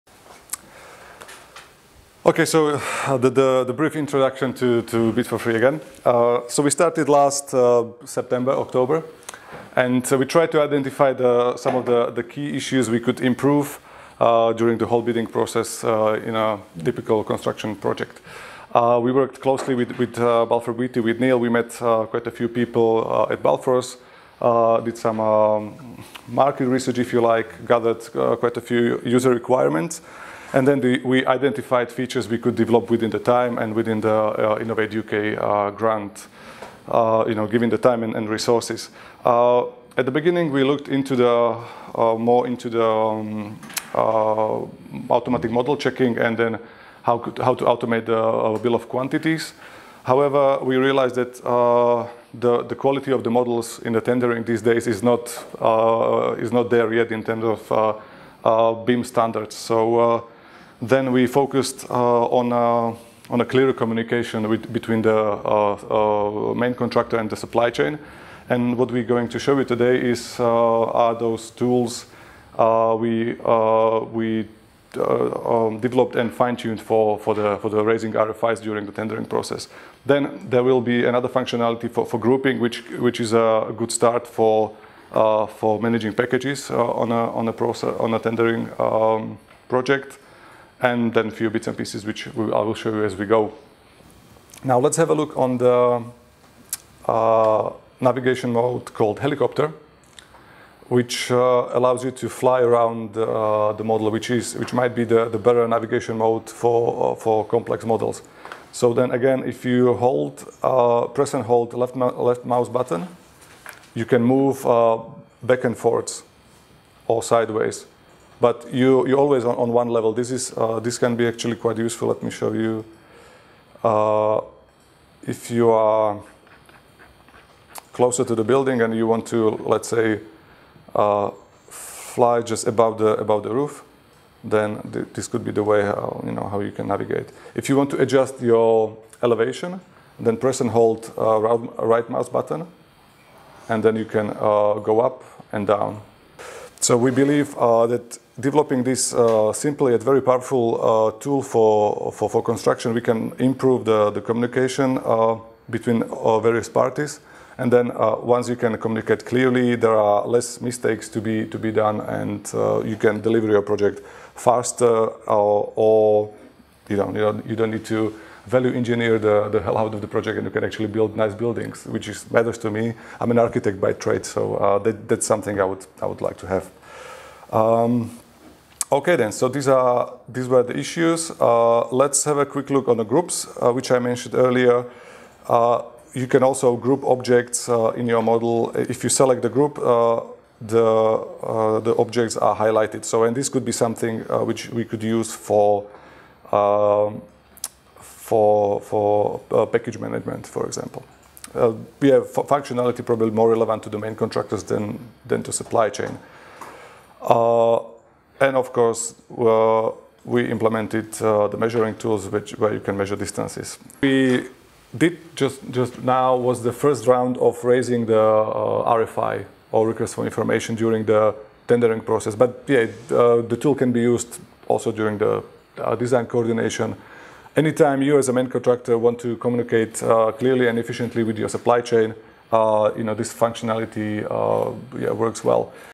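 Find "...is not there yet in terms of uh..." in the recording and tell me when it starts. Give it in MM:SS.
00:56.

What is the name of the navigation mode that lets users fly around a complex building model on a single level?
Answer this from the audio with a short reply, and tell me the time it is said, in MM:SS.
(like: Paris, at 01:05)
helicopter, at 01:39.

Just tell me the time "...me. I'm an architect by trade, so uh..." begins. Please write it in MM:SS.
02:52.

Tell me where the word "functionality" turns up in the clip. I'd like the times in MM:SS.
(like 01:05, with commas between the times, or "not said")
01:21, 03:22, 03:53.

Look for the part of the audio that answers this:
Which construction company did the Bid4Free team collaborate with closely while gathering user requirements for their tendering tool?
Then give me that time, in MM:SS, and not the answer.
00:20.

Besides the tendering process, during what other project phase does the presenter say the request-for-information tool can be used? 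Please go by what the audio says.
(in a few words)
design coordination.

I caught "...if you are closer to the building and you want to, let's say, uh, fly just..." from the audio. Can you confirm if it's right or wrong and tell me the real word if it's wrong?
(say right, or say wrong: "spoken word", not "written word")
right.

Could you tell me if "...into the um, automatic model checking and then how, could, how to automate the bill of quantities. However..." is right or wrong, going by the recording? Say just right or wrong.
right.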